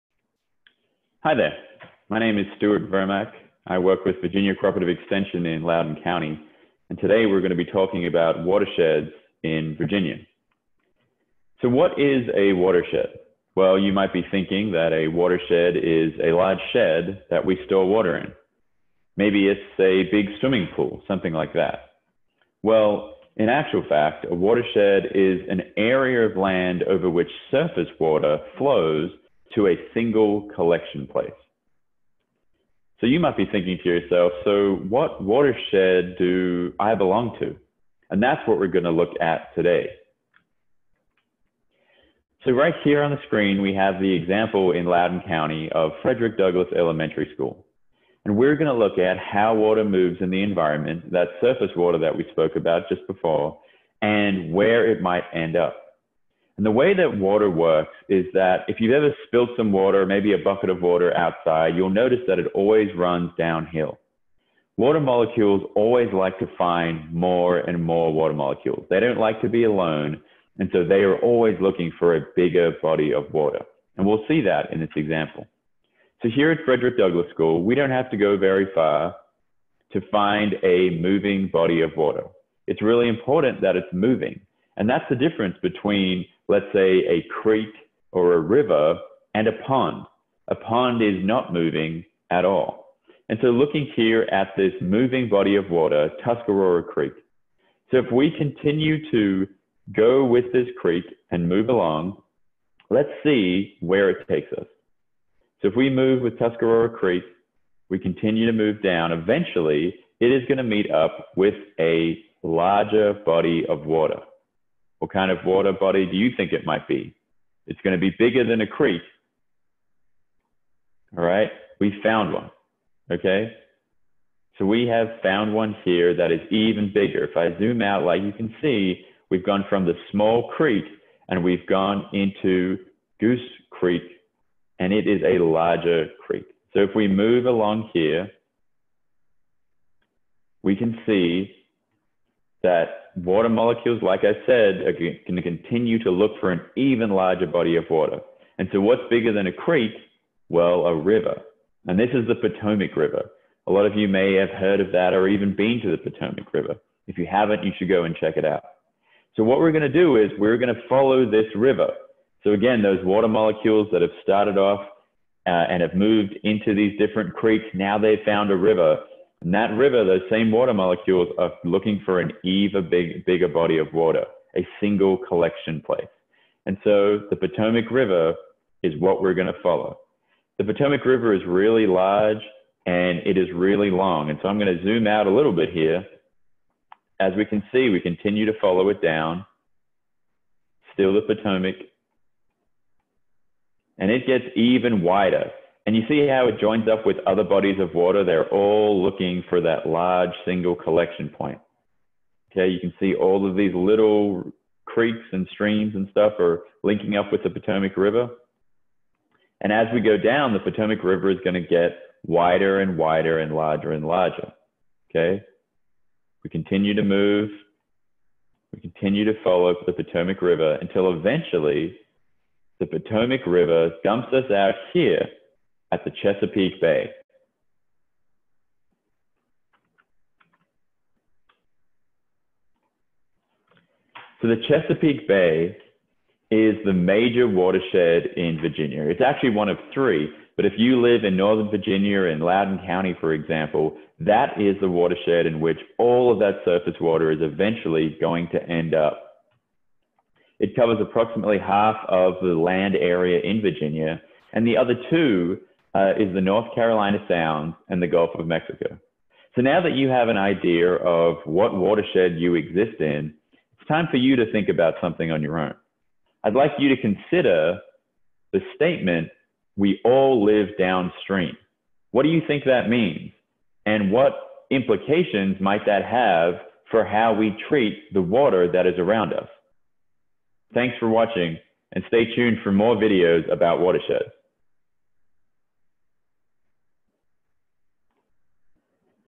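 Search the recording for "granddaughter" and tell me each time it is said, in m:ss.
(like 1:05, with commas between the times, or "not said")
not said.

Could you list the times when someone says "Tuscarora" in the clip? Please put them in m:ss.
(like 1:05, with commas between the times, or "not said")
1:36, 1:46.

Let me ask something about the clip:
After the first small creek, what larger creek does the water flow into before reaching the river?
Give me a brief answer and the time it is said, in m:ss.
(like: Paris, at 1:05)
Goose Creek, at 2:13.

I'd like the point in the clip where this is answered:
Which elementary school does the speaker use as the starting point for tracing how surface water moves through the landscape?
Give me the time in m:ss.
0:46.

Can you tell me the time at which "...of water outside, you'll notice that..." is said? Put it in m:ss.
1:00.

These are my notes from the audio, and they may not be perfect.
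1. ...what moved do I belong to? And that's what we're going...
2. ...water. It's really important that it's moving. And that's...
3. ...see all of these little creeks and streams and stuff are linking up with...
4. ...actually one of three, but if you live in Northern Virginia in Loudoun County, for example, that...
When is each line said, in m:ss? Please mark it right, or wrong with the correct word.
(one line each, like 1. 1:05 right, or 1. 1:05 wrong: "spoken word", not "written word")
1. 0:34 wrong: "watershed", not "moved"
2. 1:21 right
3. 3:22 right
4. 3:59 right.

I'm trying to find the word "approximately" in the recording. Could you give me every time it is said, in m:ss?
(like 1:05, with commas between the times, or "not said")
4:11.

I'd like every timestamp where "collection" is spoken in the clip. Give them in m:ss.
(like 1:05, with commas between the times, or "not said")
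0:30, 2:55, 3:20.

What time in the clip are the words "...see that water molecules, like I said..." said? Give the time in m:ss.
2:21.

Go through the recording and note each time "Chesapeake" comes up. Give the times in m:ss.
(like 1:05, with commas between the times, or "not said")
3:46, 3:54.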